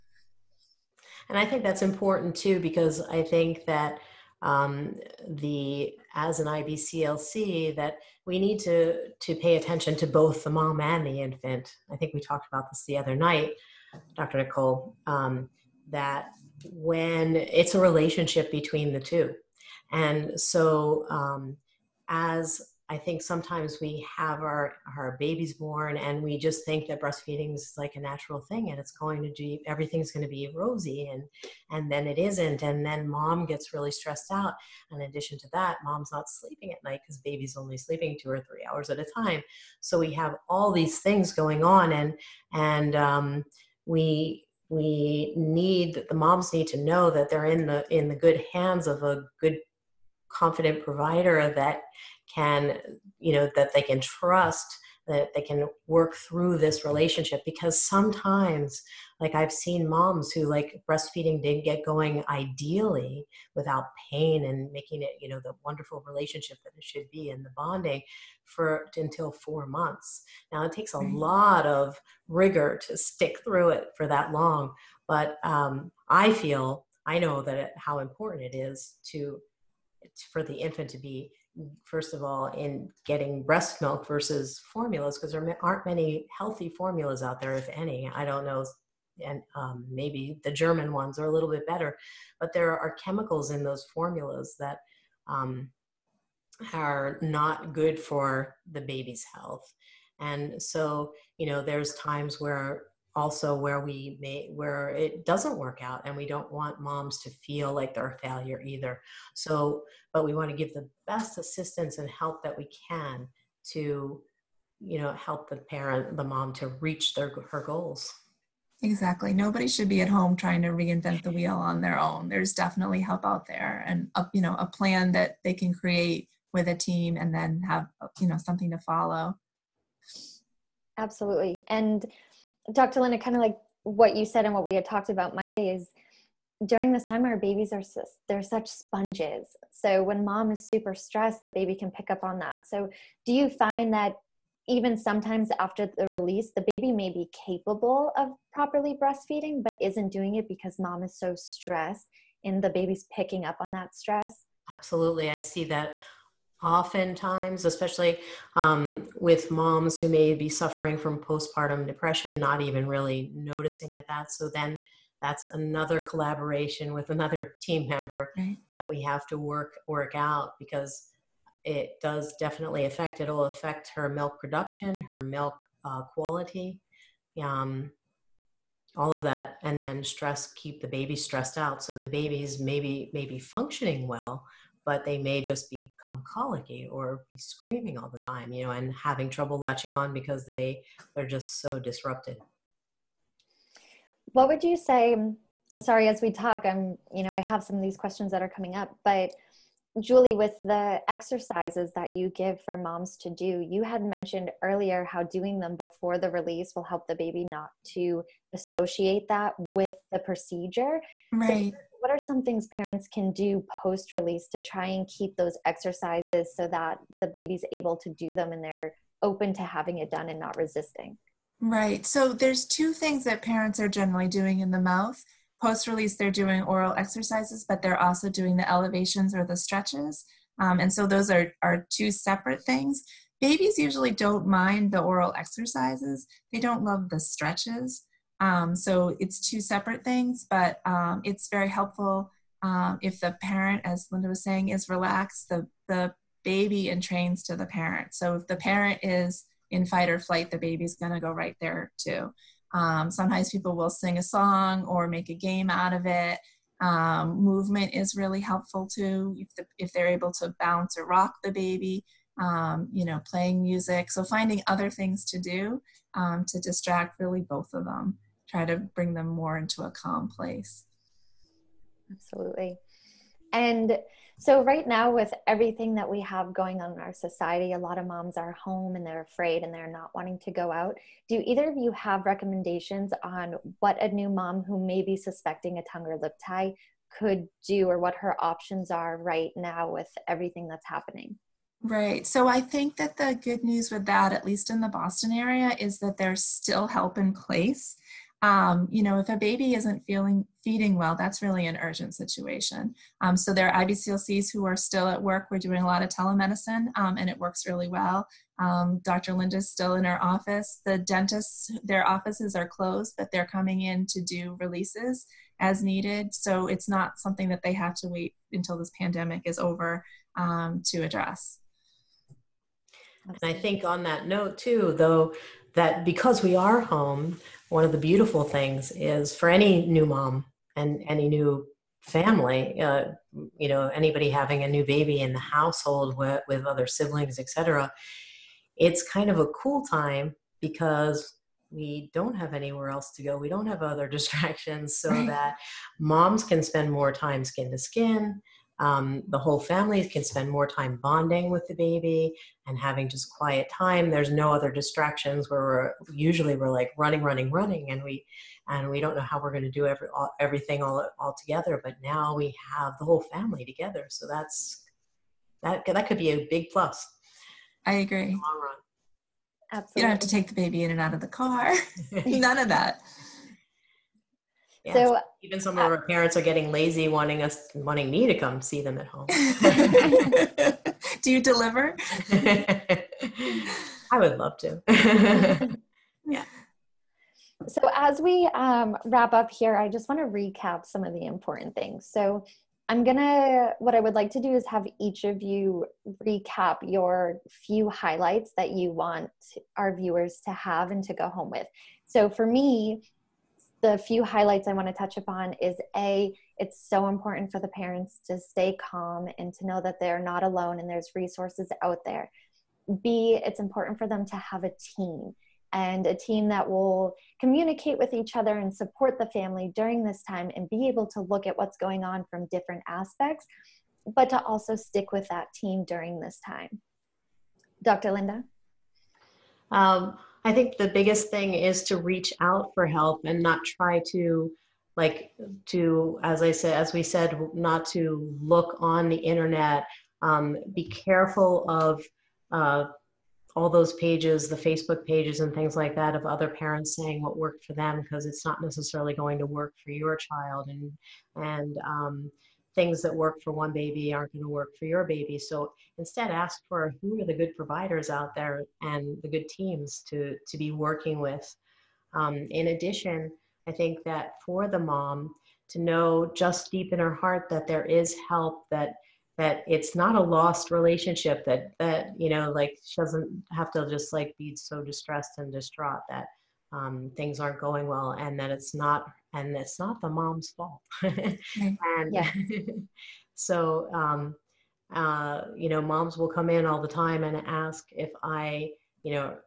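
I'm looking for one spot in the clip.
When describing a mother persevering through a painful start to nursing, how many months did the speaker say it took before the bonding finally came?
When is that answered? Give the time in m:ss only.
1:09.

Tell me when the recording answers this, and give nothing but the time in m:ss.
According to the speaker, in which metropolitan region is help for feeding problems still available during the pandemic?
4:54.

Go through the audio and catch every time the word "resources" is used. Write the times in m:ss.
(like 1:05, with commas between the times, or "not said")
6:51.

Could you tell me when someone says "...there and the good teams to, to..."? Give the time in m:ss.
7:38.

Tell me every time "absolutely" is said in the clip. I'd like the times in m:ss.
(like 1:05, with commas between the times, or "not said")
2:10, 2:34, 4:32, 6:09.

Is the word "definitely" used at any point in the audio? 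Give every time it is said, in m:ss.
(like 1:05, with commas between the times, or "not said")
2:02, 2:52.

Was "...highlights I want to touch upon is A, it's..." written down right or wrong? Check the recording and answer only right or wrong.
right.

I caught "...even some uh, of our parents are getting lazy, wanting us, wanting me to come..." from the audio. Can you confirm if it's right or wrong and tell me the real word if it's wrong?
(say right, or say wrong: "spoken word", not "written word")
right.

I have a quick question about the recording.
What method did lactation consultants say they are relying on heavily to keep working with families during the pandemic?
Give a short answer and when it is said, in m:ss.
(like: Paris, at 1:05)
telemedicine, at 5:06.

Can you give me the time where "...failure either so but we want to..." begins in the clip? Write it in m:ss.
1:48.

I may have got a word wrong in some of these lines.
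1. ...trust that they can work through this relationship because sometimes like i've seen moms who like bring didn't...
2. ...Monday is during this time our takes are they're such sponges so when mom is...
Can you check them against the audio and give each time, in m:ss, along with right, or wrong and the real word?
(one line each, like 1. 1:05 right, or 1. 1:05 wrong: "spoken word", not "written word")
1. 0:53 wrong: "breastfeeding", not "bring"
2. 2:15 wrong: "babies", not "takes".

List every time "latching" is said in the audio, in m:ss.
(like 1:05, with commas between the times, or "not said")
3:09.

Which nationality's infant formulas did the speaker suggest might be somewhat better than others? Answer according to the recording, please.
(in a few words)
German.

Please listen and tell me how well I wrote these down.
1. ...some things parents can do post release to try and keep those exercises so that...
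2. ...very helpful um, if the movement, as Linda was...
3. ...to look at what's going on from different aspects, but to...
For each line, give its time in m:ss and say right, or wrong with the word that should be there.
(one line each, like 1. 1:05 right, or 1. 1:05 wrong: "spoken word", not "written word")
1. 3:32 right
2. 4:01 wrong: "parent", not "movement"
3. 7:01 right.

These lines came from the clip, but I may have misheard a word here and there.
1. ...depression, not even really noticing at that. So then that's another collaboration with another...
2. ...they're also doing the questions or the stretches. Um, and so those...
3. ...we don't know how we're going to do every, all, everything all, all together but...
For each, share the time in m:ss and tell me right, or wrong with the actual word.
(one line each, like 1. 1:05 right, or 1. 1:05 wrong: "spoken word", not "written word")
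1. 2:41 right
2. 3:47 wrong: "elevations", not "questions"
3. 5:58 right.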